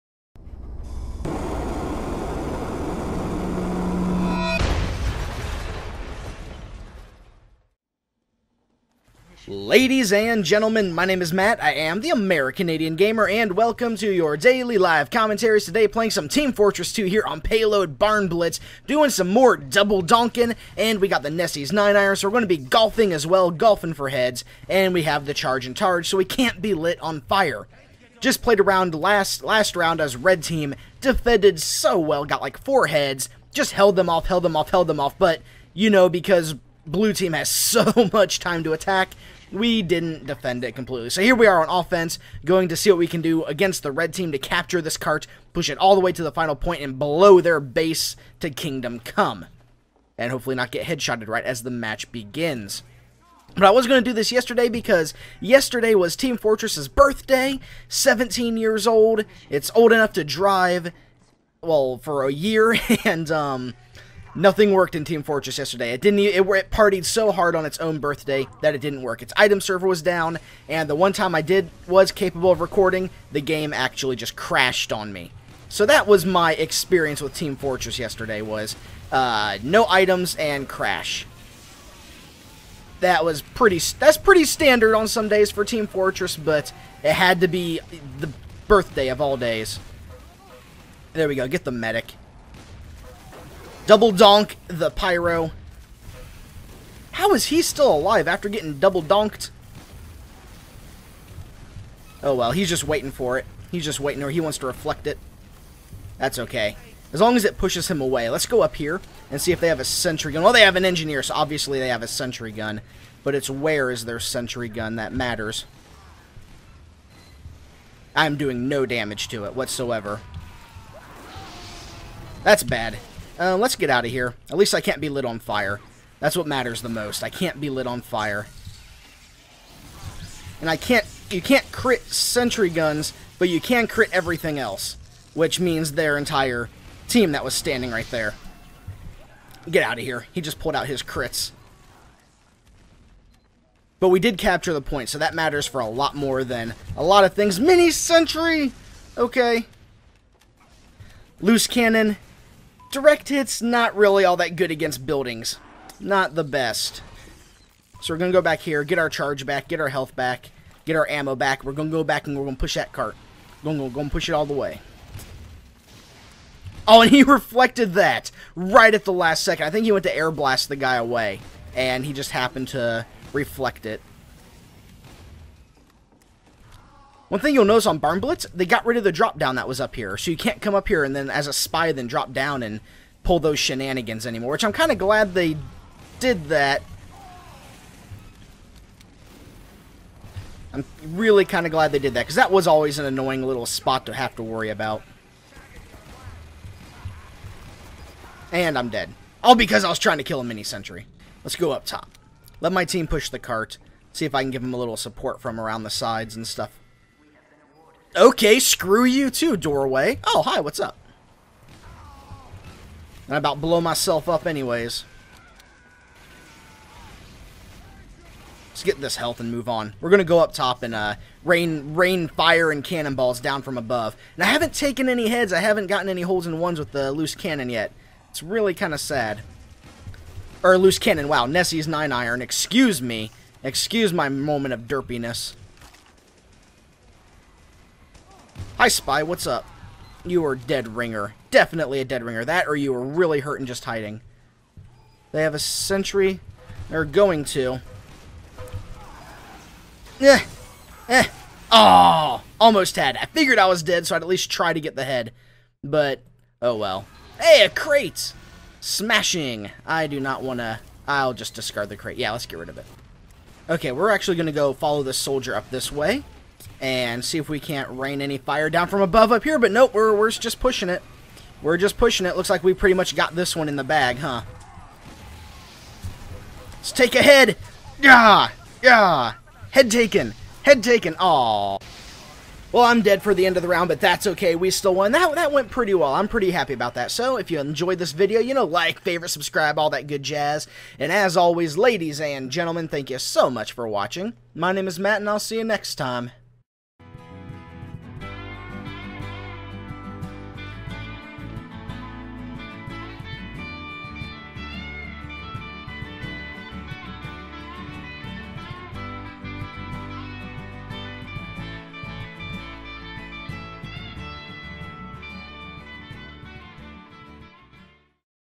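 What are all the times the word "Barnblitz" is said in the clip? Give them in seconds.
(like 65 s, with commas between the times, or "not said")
17 s, 177 s.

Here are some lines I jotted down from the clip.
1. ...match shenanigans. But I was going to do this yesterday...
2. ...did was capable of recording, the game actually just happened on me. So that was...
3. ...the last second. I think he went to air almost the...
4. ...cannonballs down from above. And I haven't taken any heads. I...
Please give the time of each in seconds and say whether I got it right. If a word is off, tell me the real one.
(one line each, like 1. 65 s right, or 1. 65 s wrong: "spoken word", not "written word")
1. 51 s wrong: "begins", not "shenanigans"
2. 71 s wrong: "crashed", not "happened"
3. 169 s wrong: "blast", not "almost"
4. 222 s right.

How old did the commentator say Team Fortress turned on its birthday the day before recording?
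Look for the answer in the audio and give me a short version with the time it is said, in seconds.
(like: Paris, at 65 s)
17, at 57 s.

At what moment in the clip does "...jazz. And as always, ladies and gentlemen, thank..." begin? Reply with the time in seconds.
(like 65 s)
290 s.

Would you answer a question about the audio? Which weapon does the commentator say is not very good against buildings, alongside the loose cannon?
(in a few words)
Direct hit.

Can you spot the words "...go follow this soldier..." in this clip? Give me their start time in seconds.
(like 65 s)
264 s.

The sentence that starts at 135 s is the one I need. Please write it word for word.
Which means their entire team that was standing right there.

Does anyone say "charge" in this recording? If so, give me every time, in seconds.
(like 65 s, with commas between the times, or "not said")
25 s, 159 s.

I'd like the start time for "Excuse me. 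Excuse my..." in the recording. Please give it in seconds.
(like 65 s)
232 s.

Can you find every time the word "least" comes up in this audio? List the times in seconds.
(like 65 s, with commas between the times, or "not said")
124 s, 254 s.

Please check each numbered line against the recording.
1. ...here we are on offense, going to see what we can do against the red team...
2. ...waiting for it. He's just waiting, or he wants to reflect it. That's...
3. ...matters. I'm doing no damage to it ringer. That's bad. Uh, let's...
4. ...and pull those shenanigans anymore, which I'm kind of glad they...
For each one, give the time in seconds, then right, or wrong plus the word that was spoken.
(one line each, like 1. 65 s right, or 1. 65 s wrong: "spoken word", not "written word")
1. 41 s right
2. 102 s right
3. 115 s wrong: "whatsoever", not "ringer"
4. 182 s right.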